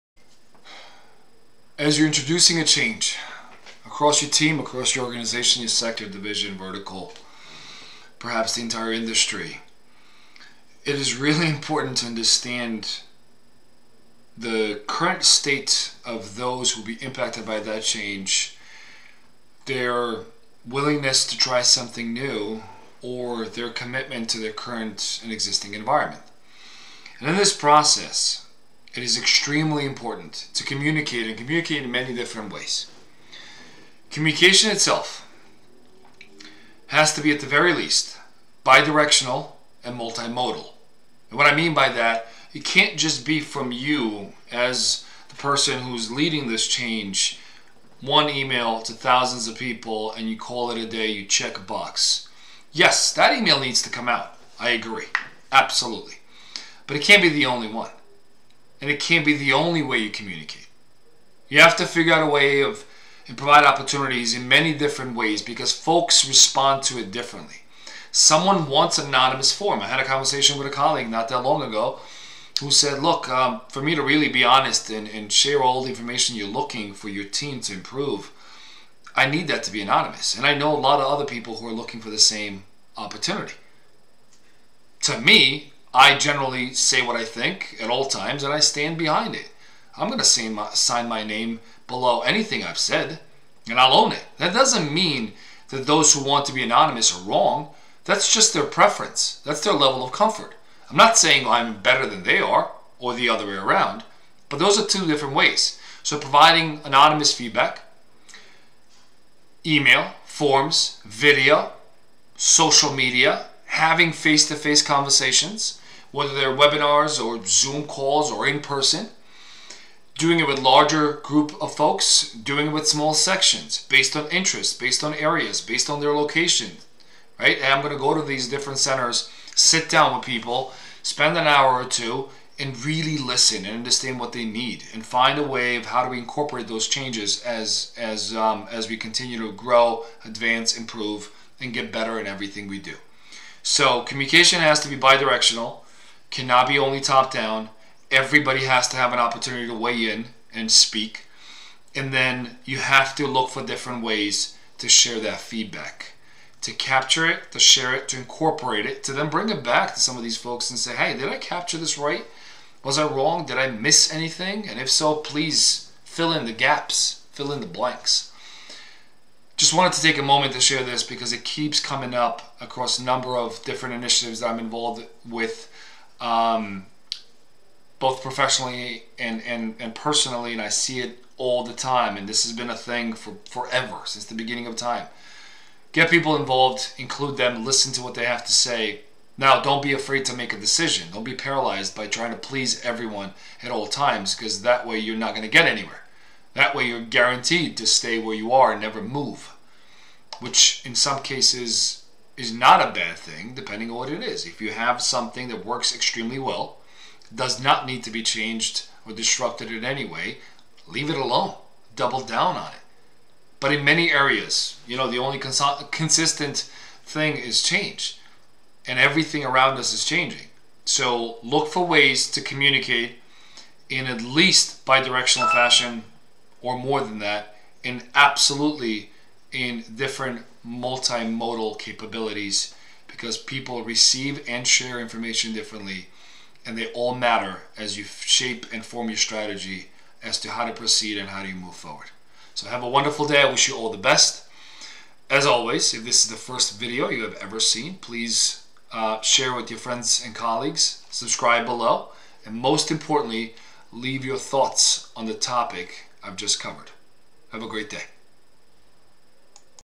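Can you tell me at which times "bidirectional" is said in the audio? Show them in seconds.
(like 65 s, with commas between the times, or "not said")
38 s, 144 s.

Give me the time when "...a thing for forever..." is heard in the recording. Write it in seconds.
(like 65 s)
182 s.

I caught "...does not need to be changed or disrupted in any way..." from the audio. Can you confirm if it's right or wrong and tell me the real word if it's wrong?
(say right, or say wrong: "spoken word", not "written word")
right.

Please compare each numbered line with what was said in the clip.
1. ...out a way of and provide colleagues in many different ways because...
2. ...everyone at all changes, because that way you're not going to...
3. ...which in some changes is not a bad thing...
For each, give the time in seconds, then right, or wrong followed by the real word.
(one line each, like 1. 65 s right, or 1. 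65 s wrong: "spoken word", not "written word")
1. 62 s wrong: "opportunities", not "colleagues"
2. 192 s wrong: "times", not "changes"
3. 200 s wrong: "cases", not "changes".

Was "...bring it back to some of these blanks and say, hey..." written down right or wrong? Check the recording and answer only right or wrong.
wrong.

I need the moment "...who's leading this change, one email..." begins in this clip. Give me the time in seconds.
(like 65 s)
45 s.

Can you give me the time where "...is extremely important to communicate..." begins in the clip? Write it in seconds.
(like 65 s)
29 s.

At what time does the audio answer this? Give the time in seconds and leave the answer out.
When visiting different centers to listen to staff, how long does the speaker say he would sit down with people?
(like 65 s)
131 s.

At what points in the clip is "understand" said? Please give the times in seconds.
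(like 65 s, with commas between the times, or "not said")
12 s, 133 s.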